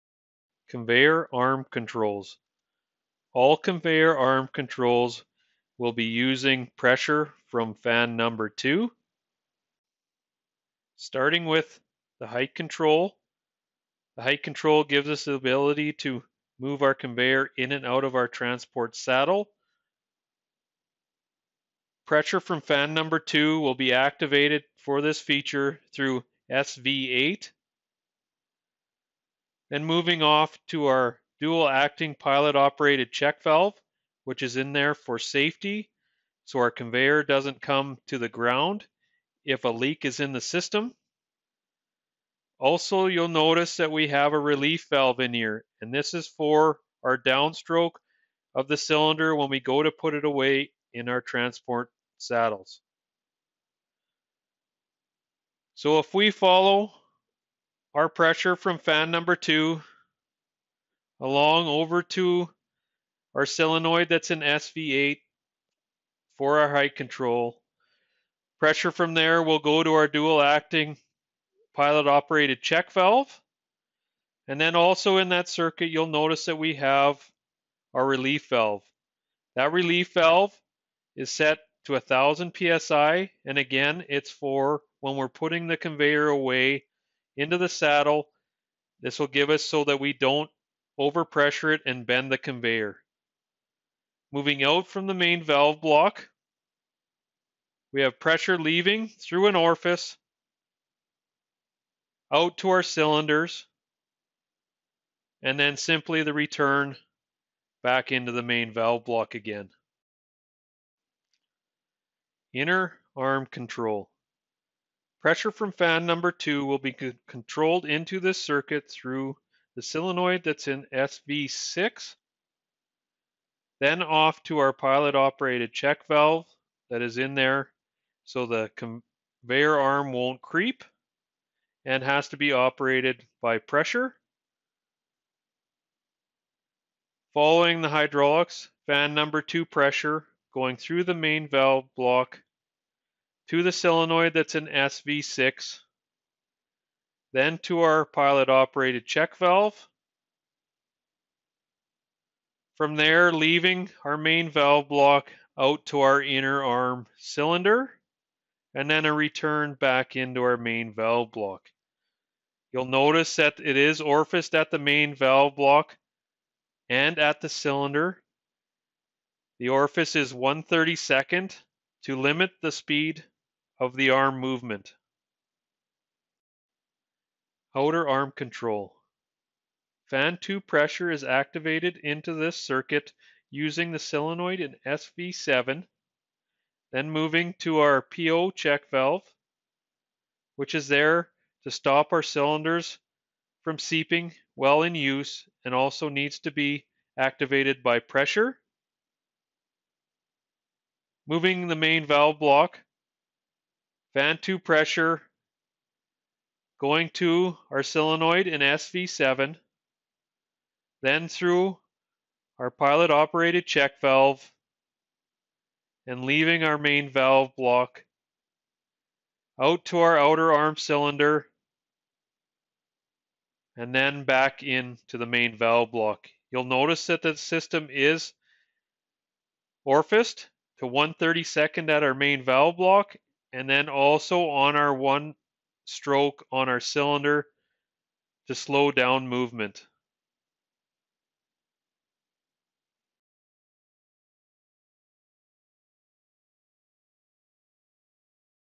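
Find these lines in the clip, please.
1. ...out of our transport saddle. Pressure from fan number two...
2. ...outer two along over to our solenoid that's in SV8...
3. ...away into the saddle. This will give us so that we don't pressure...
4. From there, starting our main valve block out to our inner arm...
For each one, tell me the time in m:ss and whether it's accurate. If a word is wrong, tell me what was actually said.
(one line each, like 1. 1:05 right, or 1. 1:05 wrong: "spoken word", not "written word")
1. 0:17 right
2. 0:59 wrong: "number", not "outer"
3. 1:26 wrong: "overpressure", not "pressure"
4. 2:32 wrong: "leaving", not "starting".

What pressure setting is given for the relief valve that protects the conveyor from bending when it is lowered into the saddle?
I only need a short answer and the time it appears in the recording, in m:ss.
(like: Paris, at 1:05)
1000 psi, at 1:21.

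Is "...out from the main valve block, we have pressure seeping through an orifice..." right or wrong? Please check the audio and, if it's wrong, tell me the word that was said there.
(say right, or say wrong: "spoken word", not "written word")
wrong: "leaving", not "seeping".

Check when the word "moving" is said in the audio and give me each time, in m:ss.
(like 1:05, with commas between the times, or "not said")
0:29, 1:34, 3:07, 3:21.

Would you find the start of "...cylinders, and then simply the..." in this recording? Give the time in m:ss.
1:42.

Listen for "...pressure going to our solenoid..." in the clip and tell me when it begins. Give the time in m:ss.
3:24.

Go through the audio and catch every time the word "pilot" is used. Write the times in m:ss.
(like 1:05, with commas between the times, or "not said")
0:32, 1:11, 2:04, 2:28, 3:32.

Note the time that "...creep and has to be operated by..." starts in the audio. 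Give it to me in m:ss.
2:10.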